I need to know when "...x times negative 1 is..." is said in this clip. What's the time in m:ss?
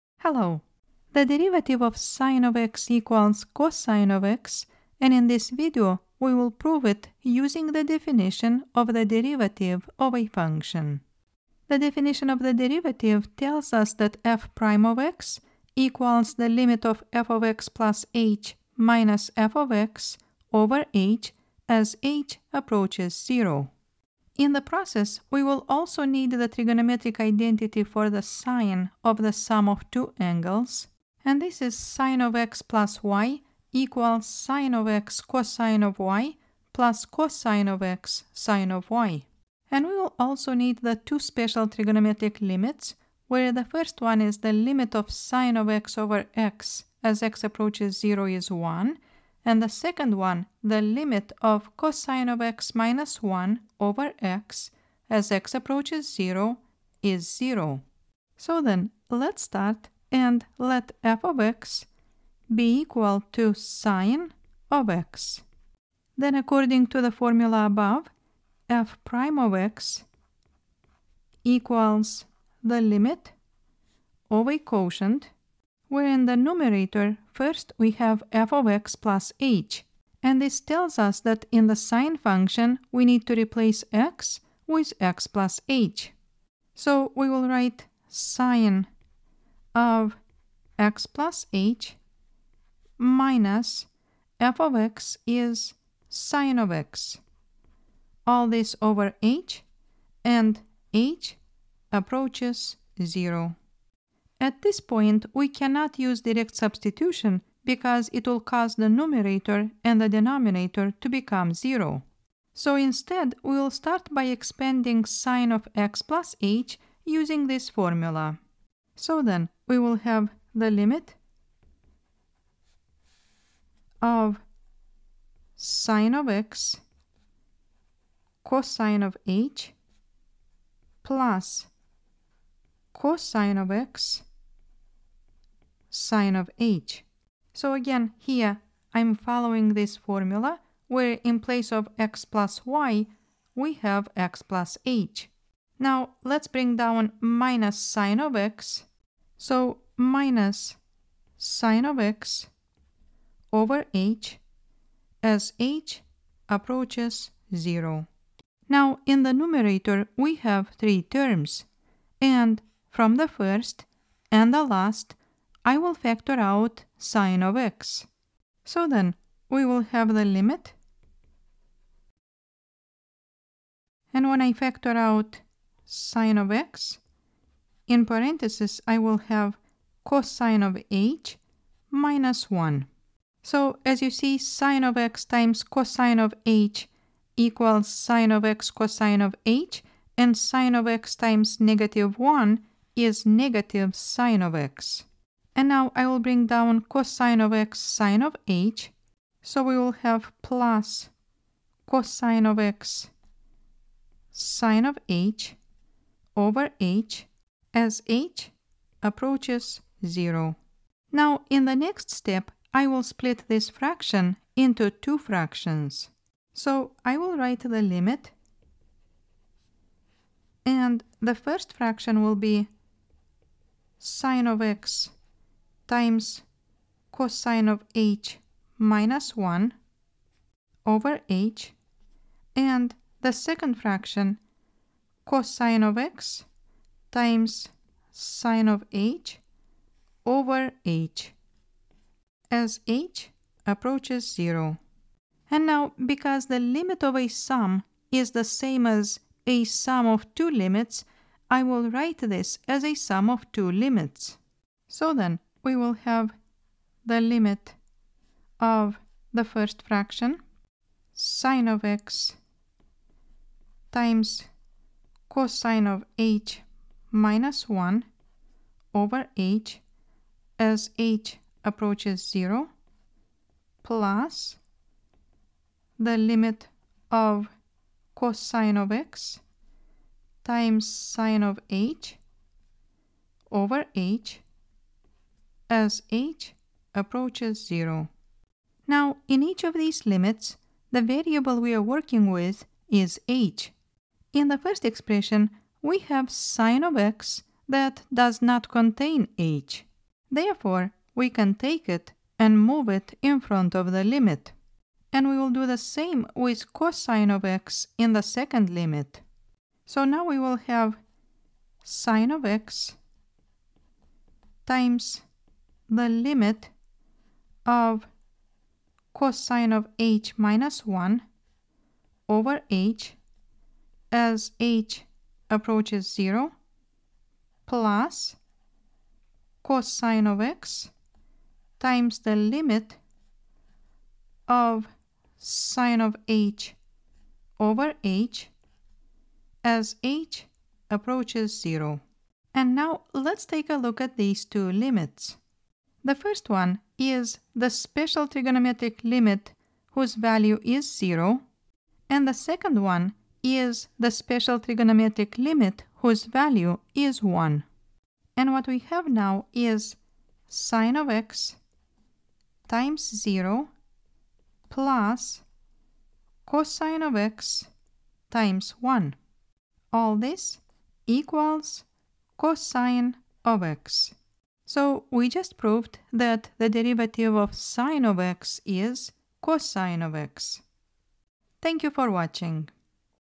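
3:10.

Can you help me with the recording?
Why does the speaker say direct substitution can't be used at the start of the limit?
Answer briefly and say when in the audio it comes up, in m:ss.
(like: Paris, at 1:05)
numerator and denominator become 0, at 1:48.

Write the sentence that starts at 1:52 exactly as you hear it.
So instead, we will start by expanding sine of x plus h using this formula.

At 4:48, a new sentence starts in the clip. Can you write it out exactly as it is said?
Now, in each of these limits, the variable we are working with is h.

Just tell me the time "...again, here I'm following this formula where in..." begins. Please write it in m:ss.
2:17.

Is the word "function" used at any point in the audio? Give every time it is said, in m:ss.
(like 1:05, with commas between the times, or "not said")
0:10, 1:22.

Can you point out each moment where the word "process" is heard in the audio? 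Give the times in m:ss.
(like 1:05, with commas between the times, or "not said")
0:24.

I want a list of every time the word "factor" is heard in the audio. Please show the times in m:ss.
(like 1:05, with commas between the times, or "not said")
2:45, 2:54.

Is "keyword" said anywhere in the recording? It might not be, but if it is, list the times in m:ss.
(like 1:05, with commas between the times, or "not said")
not said.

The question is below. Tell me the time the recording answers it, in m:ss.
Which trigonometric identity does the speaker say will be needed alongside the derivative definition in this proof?
0:28.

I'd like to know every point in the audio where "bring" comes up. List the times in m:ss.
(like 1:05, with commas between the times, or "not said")
2:26, 3:16.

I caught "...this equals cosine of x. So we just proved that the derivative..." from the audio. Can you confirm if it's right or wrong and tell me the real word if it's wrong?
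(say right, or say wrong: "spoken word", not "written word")
right.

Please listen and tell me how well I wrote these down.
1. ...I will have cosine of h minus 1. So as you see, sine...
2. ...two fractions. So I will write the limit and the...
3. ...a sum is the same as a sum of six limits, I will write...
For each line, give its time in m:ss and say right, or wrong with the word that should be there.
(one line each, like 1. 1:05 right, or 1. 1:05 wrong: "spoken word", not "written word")
1. 2:58 right
2. 3:34 right
3. 4:07 wrong: "two", not "six".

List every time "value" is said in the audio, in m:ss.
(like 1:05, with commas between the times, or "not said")
5:50, 5:56.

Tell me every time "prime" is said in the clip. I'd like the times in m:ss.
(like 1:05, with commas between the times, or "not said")
0:14, 1:09.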